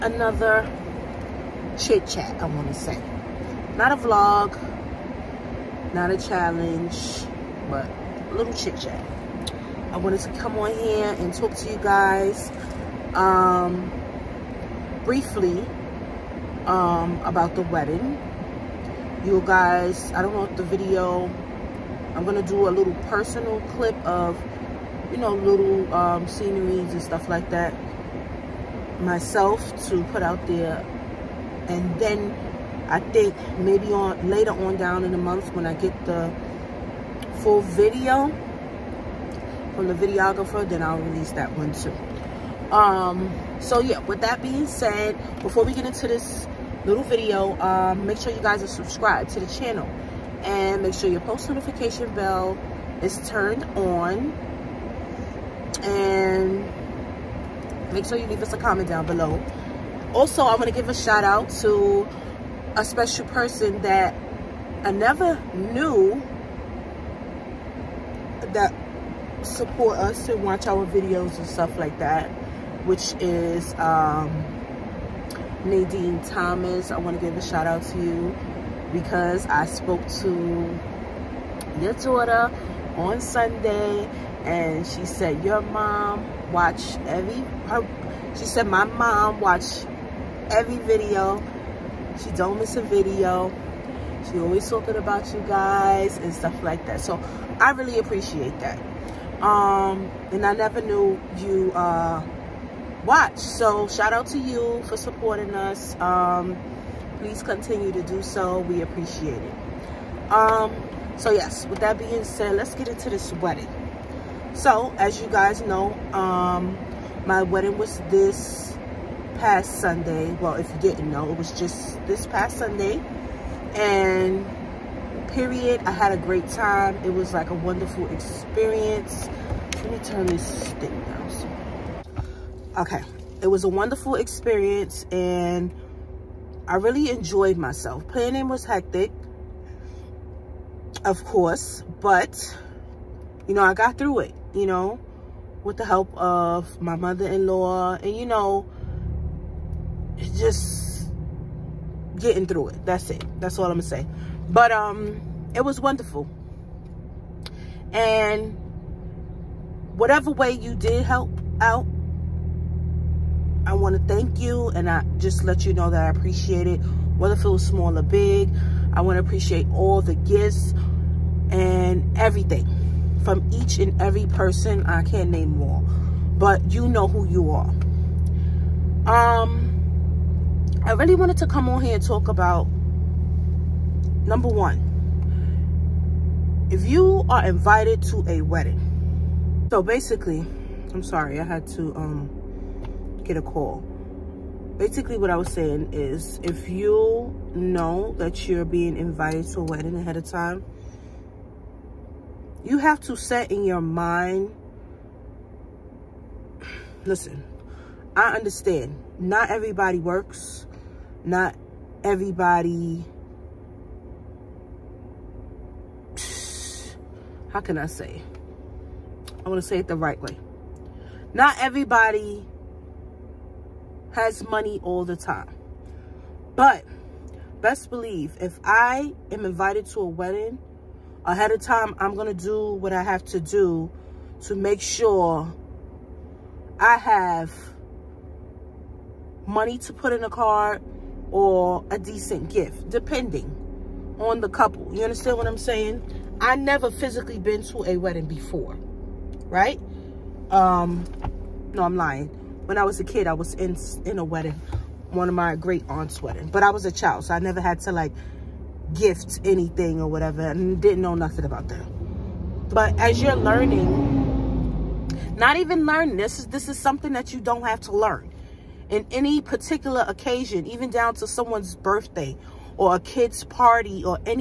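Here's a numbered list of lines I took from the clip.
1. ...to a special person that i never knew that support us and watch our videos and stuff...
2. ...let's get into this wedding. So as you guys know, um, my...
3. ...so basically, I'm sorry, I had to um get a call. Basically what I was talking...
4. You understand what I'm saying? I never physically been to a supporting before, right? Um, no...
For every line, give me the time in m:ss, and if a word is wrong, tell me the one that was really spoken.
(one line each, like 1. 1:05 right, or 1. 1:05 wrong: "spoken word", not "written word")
1. 1:01 right
2. 1:52 right
3. 3:09 wrong: "saying", not "talking"
4. 4:04 wrong: "wedding", not "supporting".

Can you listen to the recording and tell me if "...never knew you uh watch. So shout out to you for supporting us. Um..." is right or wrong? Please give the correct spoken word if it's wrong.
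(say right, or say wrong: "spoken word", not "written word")
right.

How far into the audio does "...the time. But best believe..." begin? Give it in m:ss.
3:45.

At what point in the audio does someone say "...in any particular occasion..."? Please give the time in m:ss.
4:28.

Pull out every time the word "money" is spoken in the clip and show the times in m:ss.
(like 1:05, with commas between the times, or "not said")
3:44, 3:59.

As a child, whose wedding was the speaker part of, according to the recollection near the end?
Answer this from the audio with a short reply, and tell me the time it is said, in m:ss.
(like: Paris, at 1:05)
Great aunt's, at 4:15.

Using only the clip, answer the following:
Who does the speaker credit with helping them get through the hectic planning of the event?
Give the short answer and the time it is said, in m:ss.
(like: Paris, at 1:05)
Mother-in-law, at 2:26.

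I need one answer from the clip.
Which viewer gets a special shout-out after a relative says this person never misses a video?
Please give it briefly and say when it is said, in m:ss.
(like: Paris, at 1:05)
Nadine Thomas, at 1:15.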